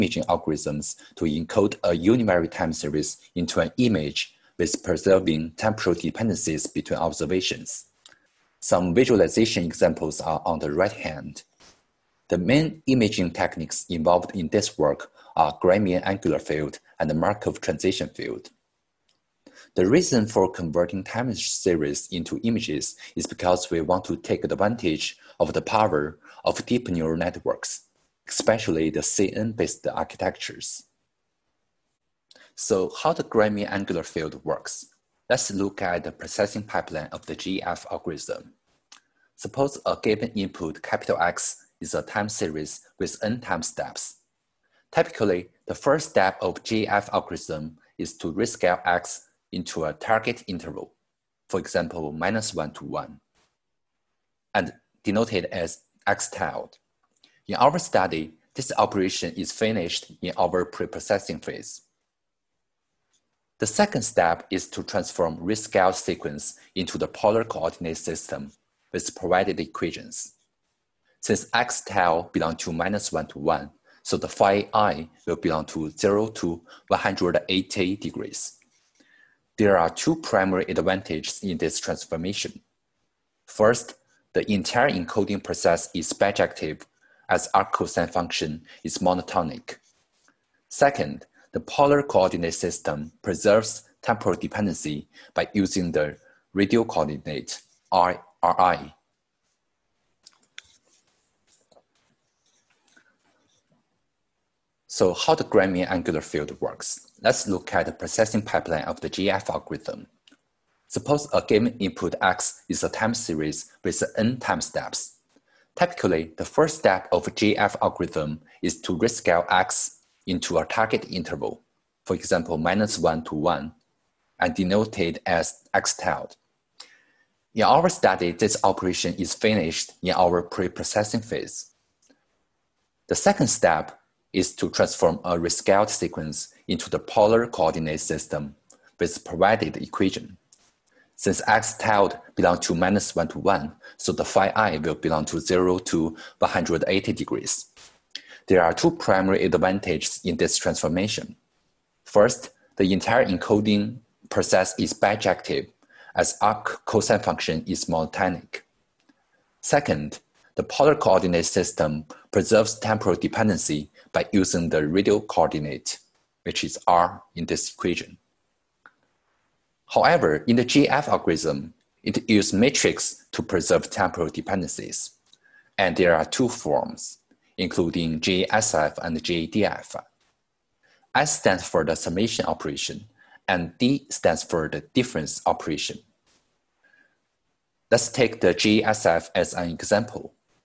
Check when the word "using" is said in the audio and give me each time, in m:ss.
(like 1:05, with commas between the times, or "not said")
1:35, 2:44.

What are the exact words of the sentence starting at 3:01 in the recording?
S stands for the summation operation, and D stands for the difference operation.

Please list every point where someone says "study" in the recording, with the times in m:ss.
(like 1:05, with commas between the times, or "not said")
0:57, 2:07.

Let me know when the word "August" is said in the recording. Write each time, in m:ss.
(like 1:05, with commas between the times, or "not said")
not said.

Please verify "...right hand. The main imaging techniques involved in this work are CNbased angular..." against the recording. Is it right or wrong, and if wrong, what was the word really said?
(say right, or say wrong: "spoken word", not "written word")
wrong: "Gramian", not "CNbased".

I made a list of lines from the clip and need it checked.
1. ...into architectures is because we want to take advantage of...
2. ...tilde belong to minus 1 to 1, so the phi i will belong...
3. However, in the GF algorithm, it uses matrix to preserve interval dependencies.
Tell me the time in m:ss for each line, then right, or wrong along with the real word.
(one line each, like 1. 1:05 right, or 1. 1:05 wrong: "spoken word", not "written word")
1. 0:22 wrong: "images", not "architectures"
2. 1:11 right
3. 2:49 wrong: "temporal", not "interval".